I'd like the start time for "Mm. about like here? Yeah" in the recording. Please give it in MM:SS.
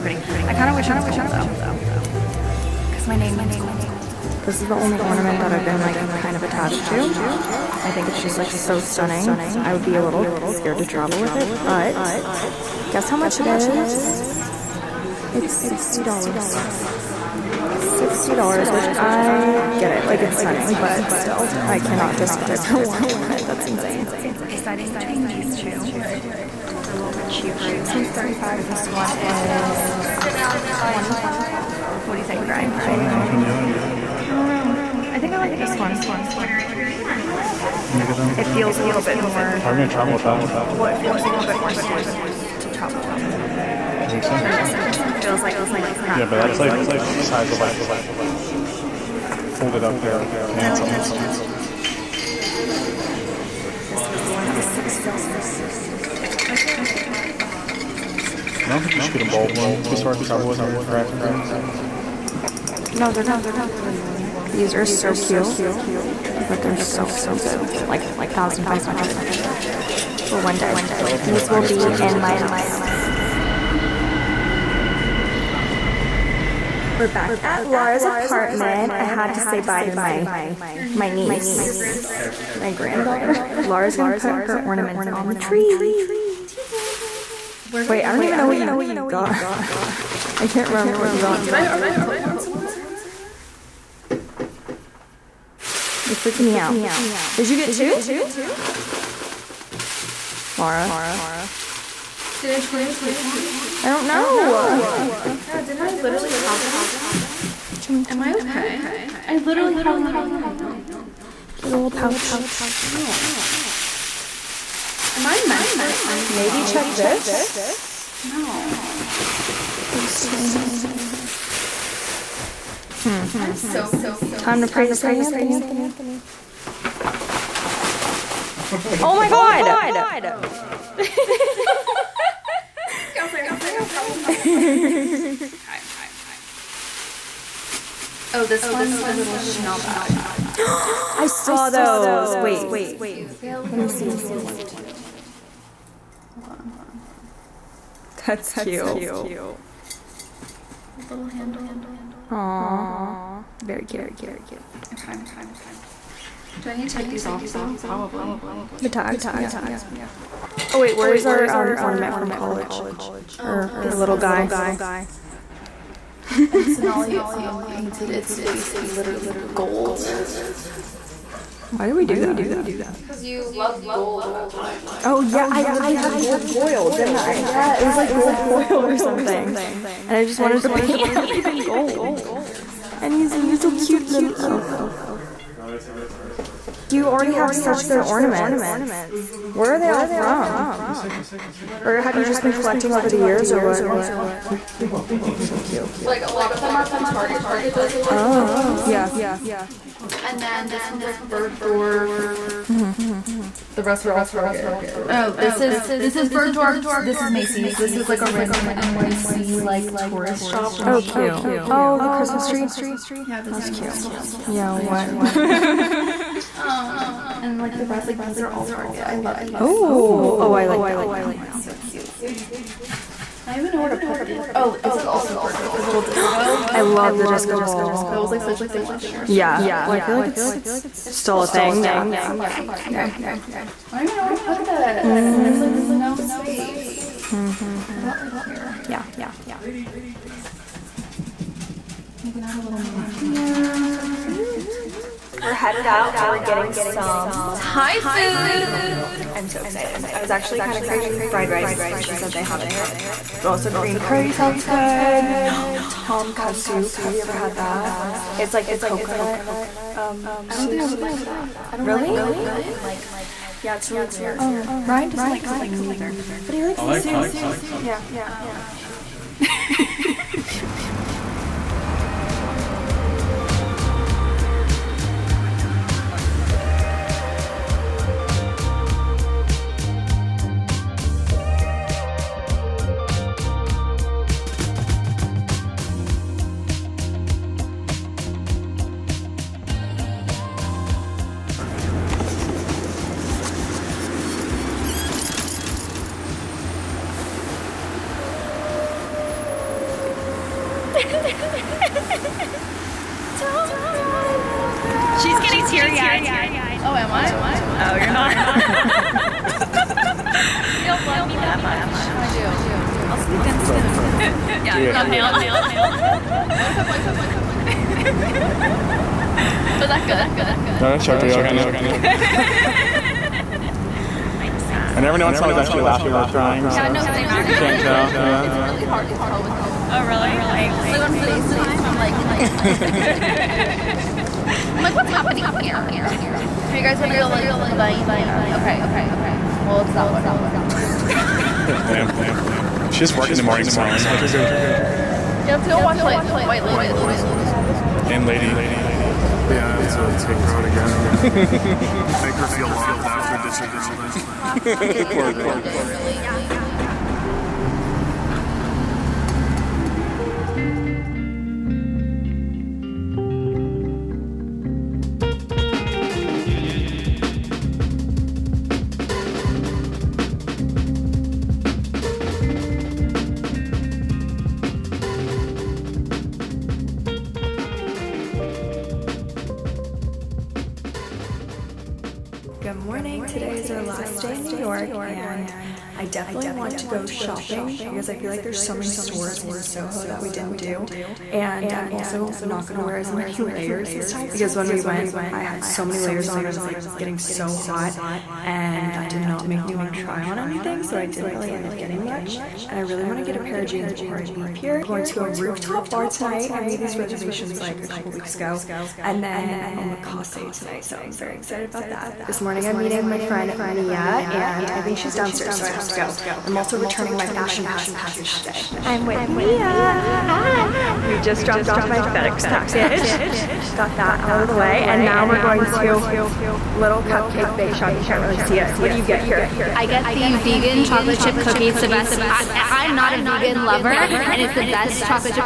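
03:57.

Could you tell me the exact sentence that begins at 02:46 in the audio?
and Sonali um, painted its face literally gold.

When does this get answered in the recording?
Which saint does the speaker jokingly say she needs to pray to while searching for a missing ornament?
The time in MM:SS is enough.
02:04.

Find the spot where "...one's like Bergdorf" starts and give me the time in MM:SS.
03:20.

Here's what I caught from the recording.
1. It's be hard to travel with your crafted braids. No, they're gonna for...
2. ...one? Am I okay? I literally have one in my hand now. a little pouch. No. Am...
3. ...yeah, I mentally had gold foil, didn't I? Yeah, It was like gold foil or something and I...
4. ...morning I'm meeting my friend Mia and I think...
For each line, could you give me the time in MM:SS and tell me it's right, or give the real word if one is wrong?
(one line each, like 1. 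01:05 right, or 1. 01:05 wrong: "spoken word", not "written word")
1. 00:59 right
2. 01:47 right
3. 02:55 wrong: "literally", not "mentally"
4. 06:52 right.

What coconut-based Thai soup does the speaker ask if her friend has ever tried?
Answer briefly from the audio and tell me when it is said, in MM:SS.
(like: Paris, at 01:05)
Tom ka soup, at 04:15.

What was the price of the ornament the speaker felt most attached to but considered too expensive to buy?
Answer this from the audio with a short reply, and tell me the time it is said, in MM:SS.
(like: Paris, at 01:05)
$60, at 00:15.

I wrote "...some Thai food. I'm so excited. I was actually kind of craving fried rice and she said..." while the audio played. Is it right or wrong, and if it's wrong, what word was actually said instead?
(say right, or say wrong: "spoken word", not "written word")
right.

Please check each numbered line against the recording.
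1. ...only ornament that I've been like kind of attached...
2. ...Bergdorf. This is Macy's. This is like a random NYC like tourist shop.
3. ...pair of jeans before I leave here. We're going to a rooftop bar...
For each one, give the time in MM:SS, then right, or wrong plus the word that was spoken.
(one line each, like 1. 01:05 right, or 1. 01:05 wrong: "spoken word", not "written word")
1. 00:04 right
2. 03:26 right
3. 06:43 right.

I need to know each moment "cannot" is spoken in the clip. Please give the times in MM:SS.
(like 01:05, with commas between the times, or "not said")
00:21.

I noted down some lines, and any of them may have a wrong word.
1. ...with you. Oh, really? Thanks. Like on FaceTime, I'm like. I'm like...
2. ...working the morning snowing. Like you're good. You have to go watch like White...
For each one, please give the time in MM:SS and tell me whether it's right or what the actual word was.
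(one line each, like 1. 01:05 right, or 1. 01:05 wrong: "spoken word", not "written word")
1. 05:29 right
2. 05:43 right.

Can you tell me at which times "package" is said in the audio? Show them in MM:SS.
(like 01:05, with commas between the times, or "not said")
06:57, 07:02.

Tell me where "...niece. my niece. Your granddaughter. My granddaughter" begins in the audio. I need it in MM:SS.
01:20.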